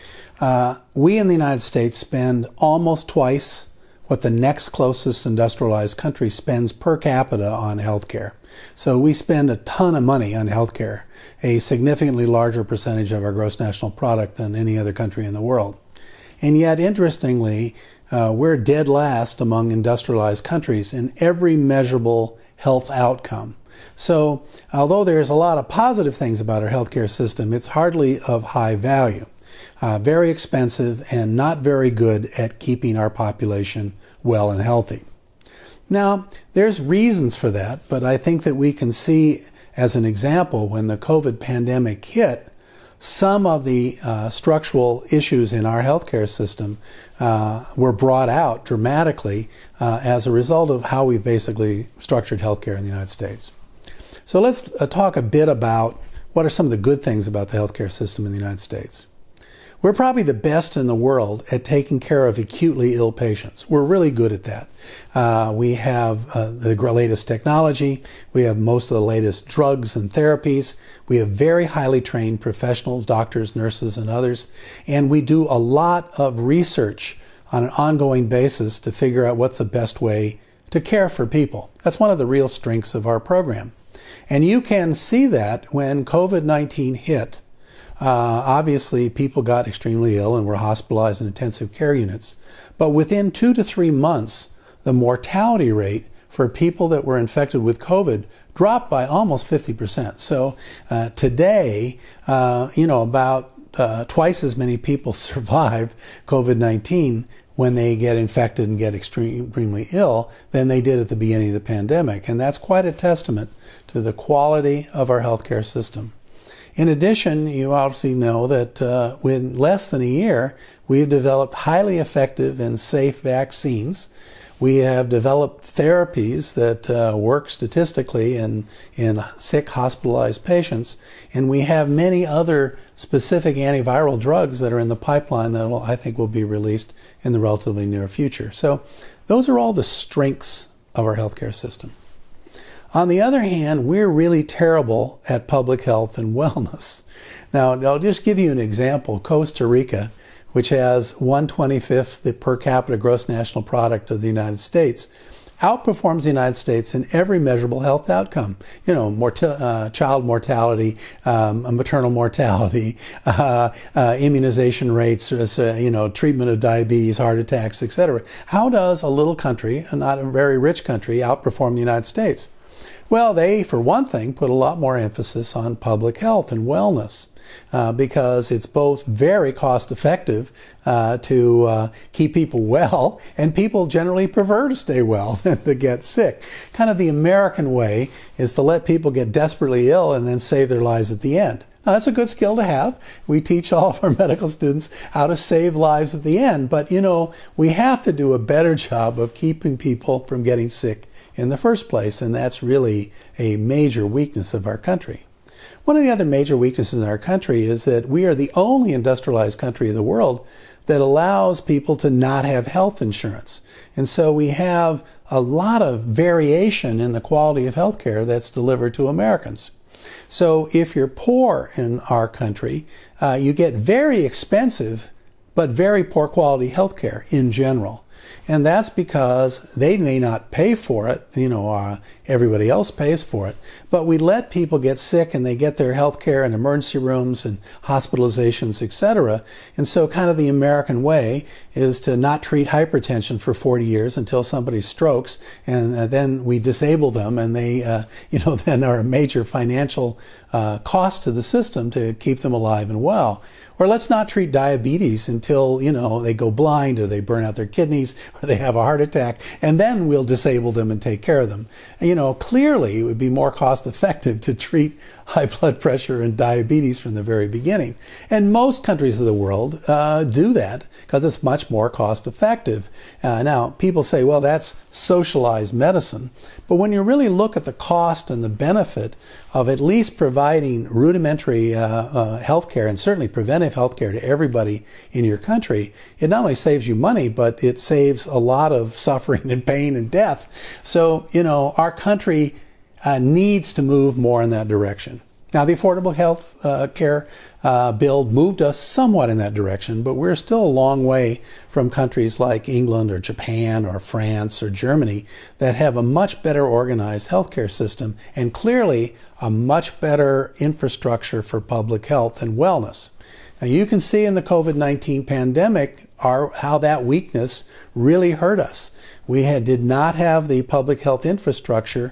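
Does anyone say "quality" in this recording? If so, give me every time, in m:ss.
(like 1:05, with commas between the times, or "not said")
1:54, 3:37, 3:46.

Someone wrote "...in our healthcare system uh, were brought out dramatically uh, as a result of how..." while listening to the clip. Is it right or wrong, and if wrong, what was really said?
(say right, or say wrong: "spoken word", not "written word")
right.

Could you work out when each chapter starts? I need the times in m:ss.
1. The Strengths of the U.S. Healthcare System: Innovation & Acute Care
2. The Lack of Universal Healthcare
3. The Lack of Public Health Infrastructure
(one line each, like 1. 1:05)
1. 0:53
2. 3:25
3. 2:21.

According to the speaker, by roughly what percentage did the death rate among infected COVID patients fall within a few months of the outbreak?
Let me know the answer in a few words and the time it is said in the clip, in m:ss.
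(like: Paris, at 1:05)
50%, at 1:39.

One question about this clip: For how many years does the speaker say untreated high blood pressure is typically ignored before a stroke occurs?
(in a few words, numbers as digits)
40.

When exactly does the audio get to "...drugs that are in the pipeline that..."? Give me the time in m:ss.
2:14.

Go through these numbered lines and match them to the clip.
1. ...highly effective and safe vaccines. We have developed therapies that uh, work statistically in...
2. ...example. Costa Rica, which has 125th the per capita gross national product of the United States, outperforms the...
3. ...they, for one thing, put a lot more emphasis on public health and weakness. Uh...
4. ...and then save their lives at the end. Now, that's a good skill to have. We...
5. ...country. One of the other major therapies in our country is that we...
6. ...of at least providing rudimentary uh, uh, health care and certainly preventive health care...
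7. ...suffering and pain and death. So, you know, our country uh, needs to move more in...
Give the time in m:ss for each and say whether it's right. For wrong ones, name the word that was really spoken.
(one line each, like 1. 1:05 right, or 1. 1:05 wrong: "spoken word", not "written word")
1. 2:01 right
2. 2:28 right
3. 2:53 wrong: "wellness", not "weakness"
4. 3:10 right
5. 3:24 wrong: "weaknesses", not "therapies"
6. 4:39 right
7. 4:48 right.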